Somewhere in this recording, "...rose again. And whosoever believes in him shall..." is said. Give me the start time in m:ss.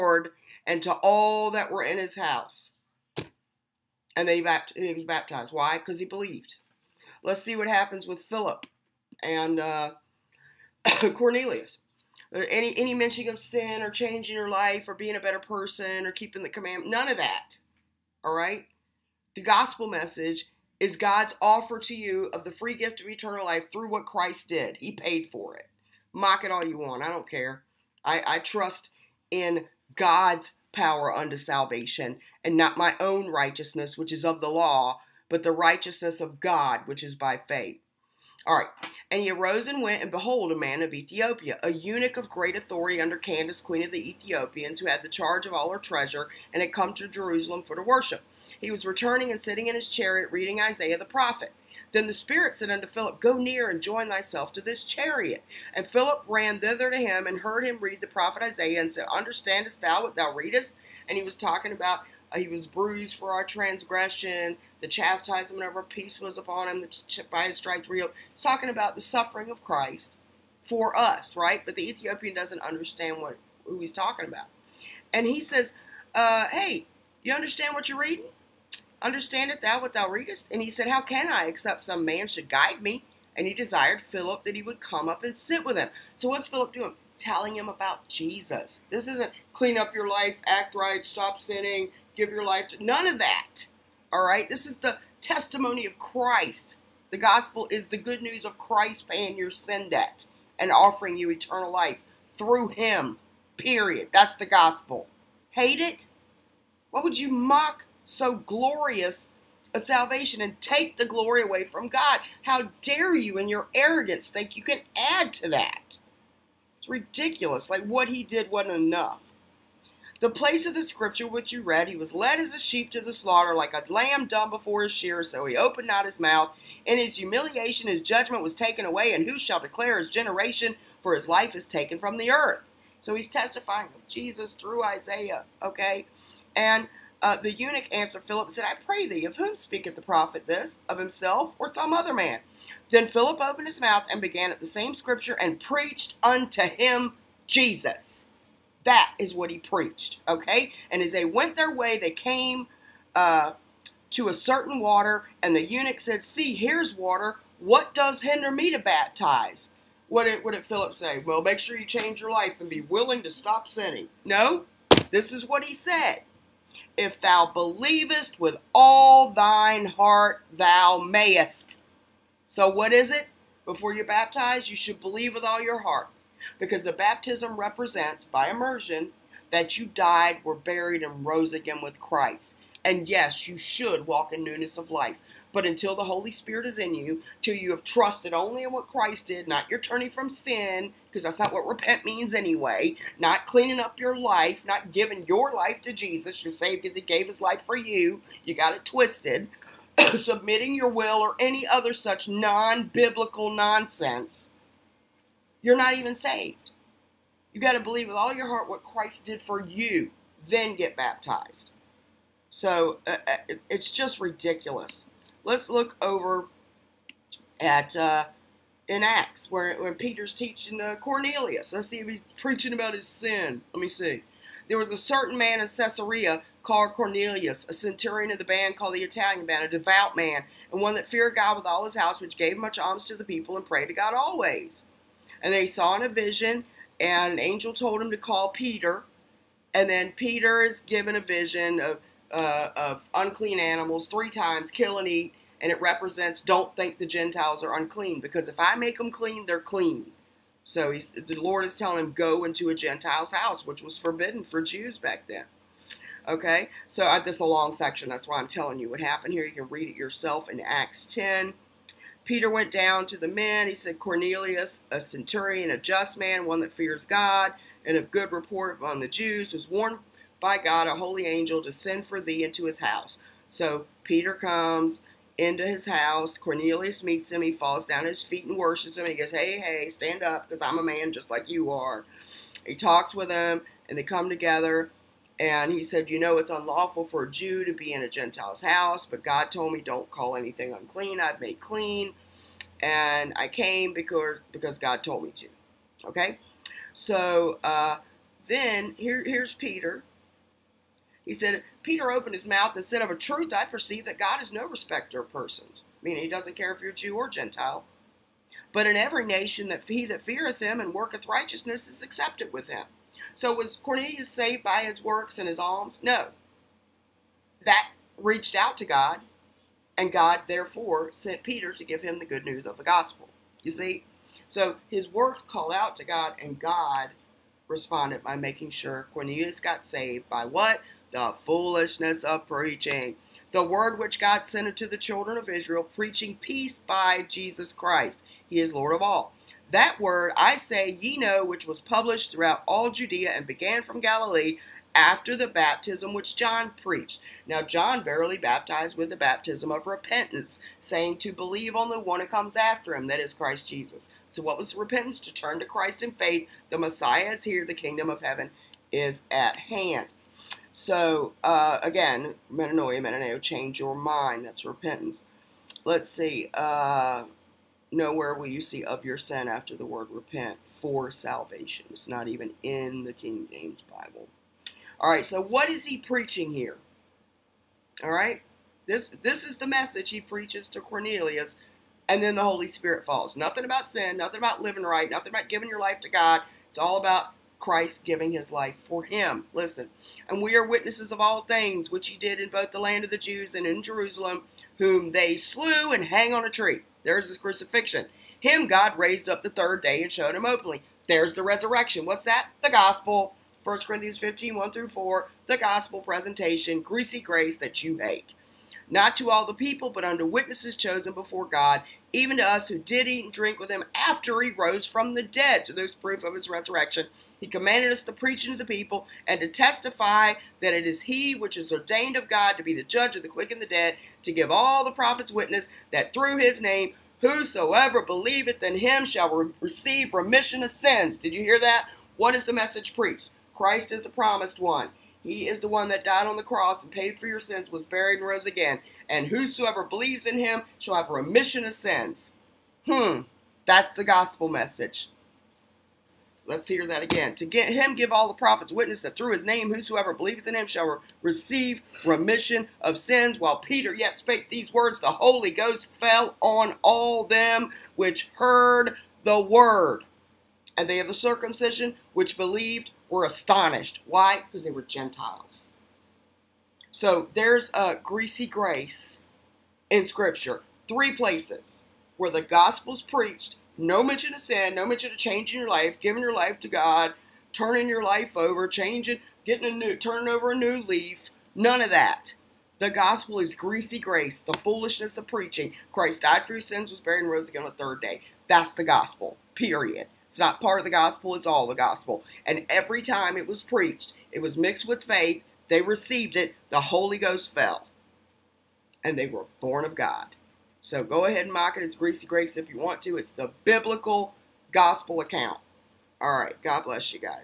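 7:18.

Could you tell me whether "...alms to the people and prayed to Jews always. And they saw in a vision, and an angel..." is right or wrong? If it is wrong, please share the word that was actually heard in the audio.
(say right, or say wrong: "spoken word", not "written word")
wrong: "God", not "Jews".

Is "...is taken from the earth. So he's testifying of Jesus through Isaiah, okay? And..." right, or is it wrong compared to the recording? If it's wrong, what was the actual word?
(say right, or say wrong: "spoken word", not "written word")
right.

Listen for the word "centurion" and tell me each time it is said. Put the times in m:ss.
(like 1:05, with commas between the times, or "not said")
3:47, 4:25.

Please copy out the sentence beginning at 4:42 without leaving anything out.
He talks with him and they come together.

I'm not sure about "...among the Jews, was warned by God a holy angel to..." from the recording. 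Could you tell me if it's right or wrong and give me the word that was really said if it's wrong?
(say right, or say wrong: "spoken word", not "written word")
right.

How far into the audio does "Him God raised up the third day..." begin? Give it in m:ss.
6:38.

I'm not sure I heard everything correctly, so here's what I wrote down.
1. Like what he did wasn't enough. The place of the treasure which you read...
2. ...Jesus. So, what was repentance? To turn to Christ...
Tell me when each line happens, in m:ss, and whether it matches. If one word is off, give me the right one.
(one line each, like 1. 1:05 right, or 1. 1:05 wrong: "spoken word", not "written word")
1. 1:57 wrong: "scripture", not "treasure"
2. 5:53 right.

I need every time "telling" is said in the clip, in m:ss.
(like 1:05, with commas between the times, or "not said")
1:27, 4:11, 4:18.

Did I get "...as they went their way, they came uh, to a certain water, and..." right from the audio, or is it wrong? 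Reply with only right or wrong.
right.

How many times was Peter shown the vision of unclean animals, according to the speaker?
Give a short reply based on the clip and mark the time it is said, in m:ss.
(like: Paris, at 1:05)
3, at 4:04.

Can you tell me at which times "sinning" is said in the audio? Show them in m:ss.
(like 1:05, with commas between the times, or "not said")
1:31, 2:43.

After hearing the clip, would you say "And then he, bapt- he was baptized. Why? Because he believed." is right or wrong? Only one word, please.
right.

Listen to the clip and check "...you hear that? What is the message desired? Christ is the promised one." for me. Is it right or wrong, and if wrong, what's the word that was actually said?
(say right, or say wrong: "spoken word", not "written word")
wrong: "preached", not "desired".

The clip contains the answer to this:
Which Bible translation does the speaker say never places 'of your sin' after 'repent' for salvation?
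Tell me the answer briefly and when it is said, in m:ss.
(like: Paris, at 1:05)
King James Bible, at 6:13.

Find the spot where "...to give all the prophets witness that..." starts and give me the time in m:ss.
7:04.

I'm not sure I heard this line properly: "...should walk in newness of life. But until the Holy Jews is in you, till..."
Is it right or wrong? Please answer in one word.
wrong.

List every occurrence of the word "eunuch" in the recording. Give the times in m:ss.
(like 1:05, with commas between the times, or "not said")
0:41, 2:17, 2:35.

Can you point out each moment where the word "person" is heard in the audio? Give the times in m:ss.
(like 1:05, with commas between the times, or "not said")
0:15, 5:05.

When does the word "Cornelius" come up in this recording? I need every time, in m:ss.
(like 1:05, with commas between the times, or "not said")
0:11, 3:40, 3:46, 4:23, 4:36, 5:13, 5:29, 6:20.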